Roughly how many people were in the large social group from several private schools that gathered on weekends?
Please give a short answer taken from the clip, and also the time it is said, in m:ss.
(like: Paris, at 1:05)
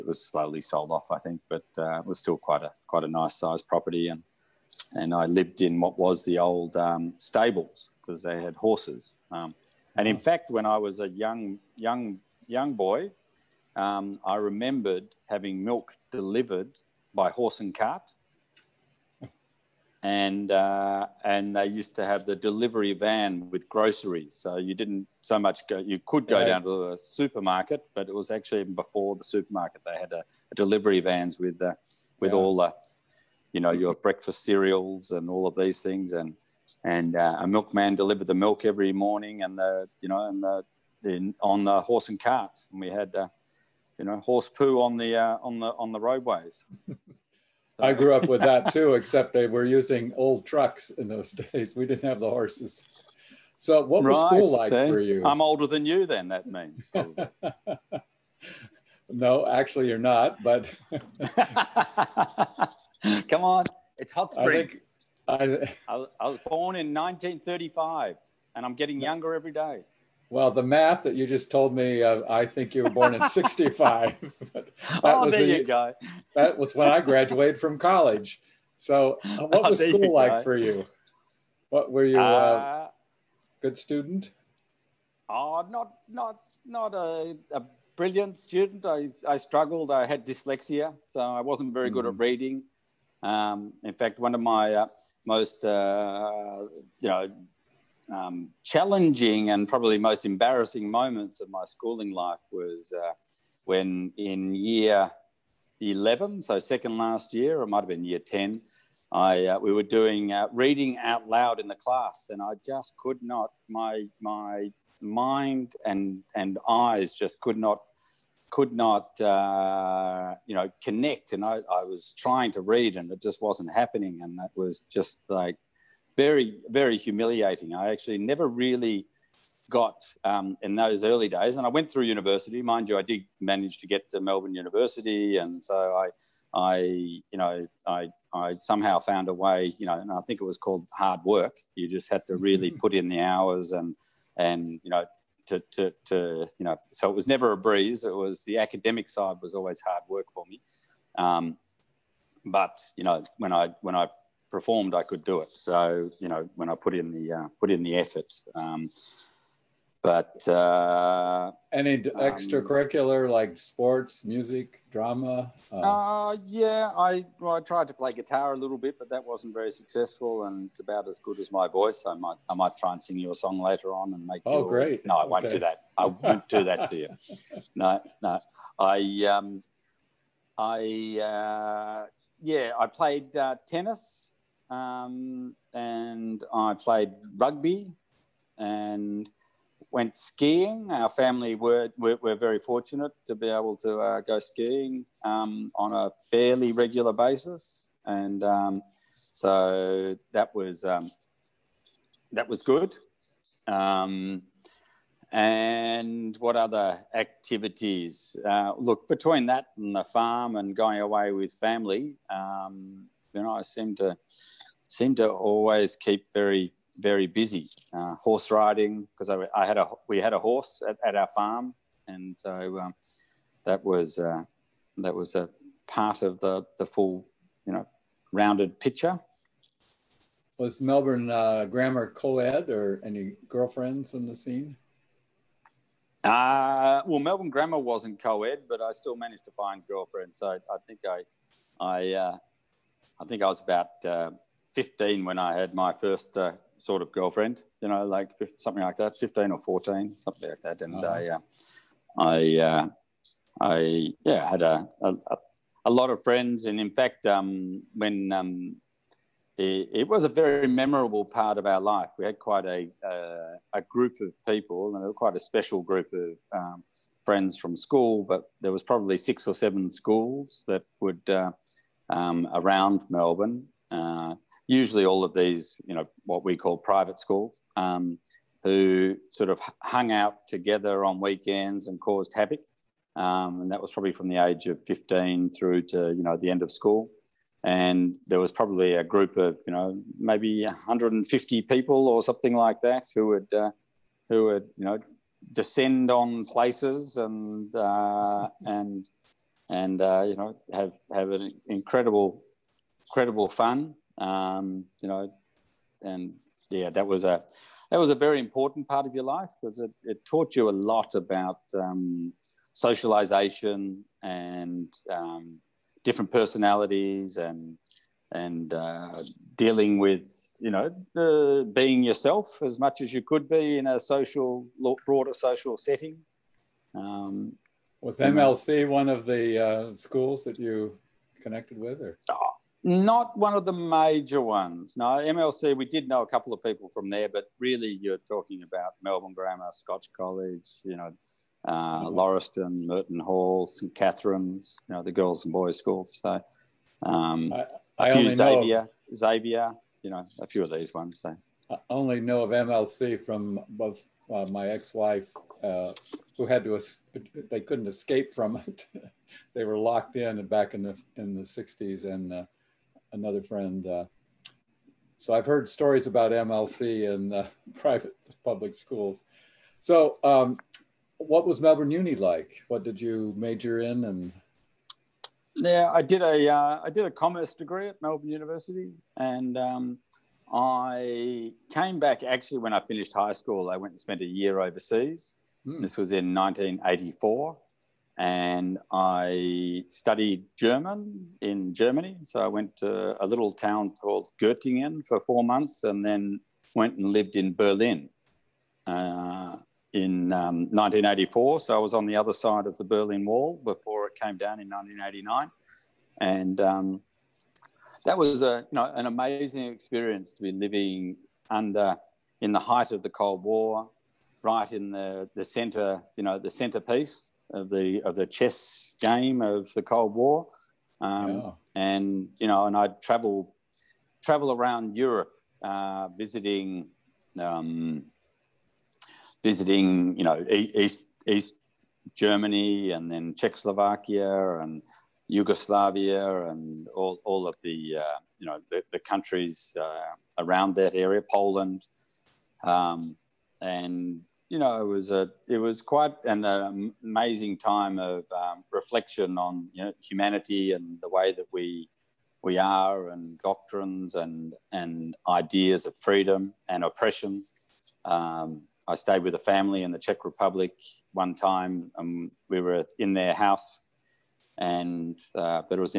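150, at 4:50.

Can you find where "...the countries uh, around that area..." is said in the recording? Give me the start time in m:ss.
7:18.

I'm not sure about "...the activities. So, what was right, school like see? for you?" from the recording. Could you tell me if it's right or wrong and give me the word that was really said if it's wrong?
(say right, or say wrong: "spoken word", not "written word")
wrong: "horses", not "activities".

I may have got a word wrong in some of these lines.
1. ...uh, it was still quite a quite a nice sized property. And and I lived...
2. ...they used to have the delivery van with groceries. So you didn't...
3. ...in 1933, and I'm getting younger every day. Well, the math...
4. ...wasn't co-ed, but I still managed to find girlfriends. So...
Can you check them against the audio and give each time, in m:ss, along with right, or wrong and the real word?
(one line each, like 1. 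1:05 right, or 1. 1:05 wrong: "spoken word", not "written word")
1. 0:01 right
2. 0:21 right
3. 1:06 wrong: "1935", not "1933"
4. 3:57 right.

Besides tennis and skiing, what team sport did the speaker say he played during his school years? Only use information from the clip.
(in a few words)
rugby.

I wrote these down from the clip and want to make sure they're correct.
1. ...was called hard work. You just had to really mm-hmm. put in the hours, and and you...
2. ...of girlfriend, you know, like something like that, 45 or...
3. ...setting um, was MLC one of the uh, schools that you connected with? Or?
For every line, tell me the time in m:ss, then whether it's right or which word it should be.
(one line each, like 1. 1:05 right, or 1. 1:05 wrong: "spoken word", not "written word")
1. 2:20 right
2. 4:07 wrong: "15", not "45"
3. 5:25 right.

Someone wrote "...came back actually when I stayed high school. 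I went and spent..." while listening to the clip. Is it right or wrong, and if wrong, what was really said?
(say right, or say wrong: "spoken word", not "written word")
wrong: "finished", not "stayed".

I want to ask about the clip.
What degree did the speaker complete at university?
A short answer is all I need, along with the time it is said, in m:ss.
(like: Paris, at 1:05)
commerce, at 6:17.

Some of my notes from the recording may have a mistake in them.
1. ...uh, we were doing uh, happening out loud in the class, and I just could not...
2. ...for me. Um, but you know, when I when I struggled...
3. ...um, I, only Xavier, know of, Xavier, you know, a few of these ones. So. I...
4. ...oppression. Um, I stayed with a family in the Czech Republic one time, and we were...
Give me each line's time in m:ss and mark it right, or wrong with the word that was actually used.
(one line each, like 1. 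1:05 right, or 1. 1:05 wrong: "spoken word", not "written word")
1. 1:49 wrong: "reading", not "happening"
2. 2:30 wrong: "performed", not "struggled"
3. 5:47 right
4. 7:36 right.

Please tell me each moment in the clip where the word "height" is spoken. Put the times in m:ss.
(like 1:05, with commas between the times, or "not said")
6:52.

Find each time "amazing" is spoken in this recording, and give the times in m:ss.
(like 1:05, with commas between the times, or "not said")
6:49, 7:27.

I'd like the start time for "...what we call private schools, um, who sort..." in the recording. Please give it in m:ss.
4:36.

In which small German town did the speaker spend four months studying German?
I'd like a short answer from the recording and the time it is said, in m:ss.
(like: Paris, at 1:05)
Göttingen, at 6:34.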